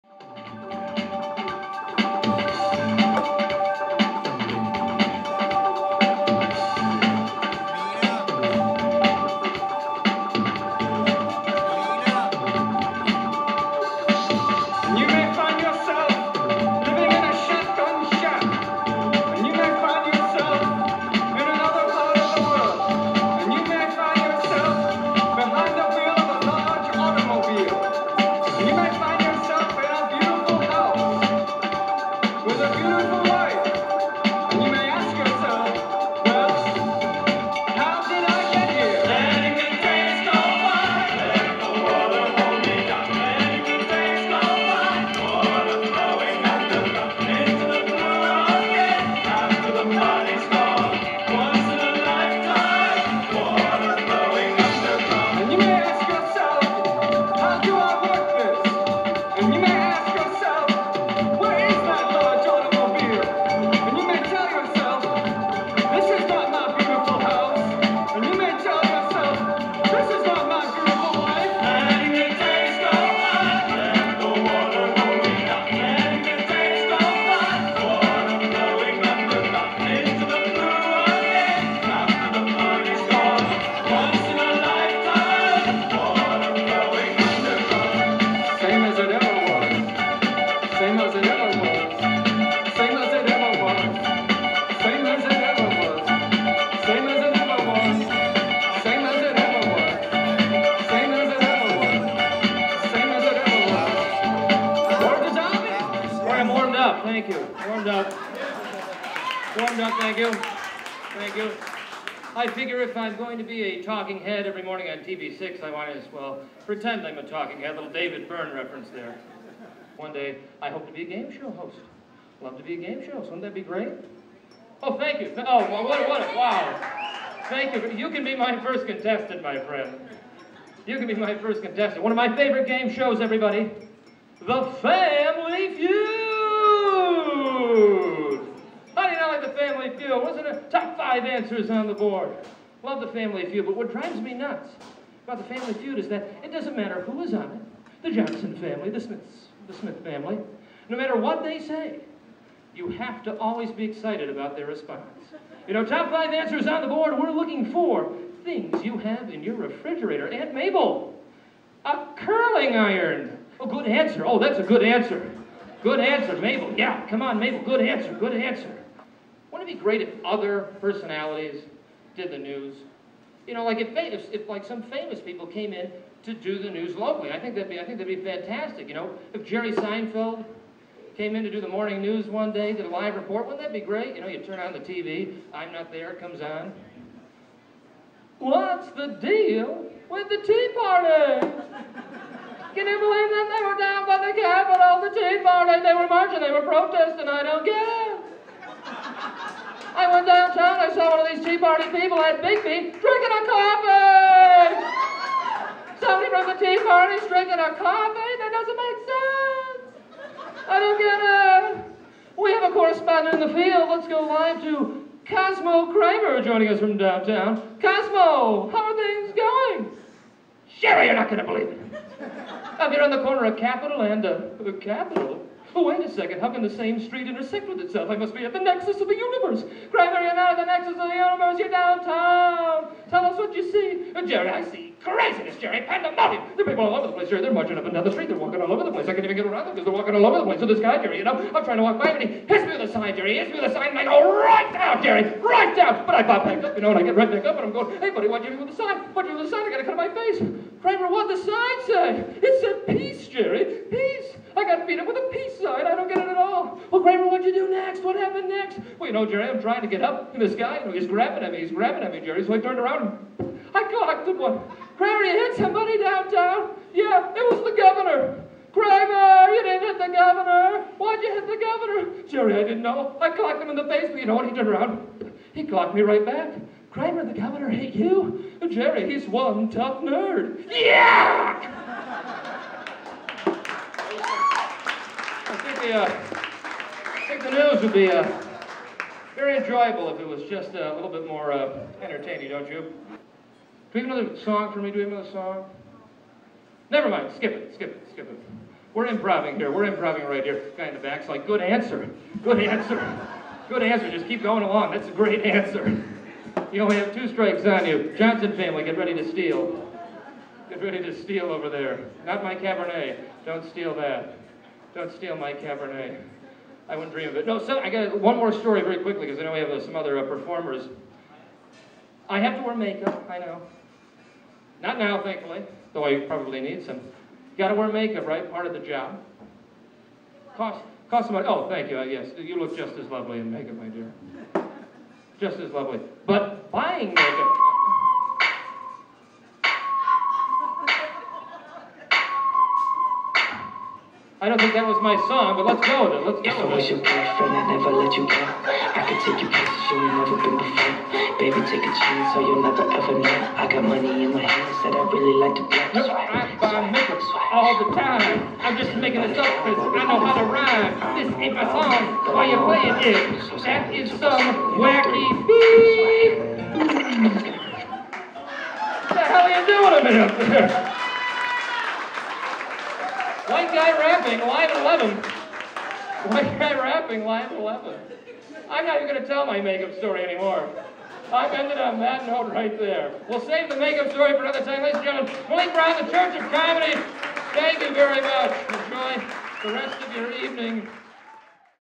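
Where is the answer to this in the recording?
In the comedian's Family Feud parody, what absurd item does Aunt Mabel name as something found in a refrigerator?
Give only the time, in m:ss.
2:41.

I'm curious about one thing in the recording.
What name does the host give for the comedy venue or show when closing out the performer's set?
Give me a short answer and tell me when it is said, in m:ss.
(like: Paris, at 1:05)
Church of Comedy, at 6:26.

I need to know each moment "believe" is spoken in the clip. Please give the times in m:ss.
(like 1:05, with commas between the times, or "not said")
3:12, 3:41.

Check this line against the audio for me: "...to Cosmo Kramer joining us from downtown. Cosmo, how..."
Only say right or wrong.
right.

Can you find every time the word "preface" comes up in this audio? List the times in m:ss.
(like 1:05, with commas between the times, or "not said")
not said.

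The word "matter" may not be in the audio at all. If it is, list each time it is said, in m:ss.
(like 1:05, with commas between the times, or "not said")
2:26, 2:30.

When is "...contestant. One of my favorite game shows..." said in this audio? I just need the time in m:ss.
2:11.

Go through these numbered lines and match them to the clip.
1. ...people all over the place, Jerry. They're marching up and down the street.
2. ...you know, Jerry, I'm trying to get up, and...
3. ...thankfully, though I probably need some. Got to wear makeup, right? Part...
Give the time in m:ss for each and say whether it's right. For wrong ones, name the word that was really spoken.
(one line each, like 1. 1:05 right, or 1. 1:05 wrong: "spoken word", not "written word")
1. 3:56 right
2. 4:19 right
3. 5:25 right.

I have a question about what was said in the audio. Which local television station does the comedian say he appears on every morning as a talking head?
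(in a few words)
TV6.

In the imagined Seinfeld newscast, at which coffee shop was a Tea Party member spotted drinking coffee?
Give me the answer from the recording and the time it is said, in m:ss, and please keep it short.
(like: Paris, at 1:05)
Biggby, at 3:22.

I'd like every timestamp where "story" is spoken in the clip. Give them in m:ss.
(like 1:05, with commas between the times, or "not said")
5:18, 6:19, 6:24.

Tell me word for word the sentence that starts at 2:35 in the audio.
You know, top five answers on the board.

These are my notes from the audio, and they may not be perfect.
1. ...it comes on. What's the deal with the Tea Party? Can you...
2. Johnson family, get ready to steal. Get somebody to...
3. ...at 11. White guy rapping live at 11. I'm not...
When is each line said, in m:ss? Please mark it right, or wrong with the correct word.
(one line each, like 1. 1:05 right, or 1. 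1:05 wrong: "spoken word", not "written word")
1. 3:06 right
2. 5:08 wrong: "ready", not "somebody"
3. 6:14 right.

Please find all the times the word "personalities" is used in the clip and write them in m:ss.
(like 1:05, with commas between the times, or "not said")
2:50.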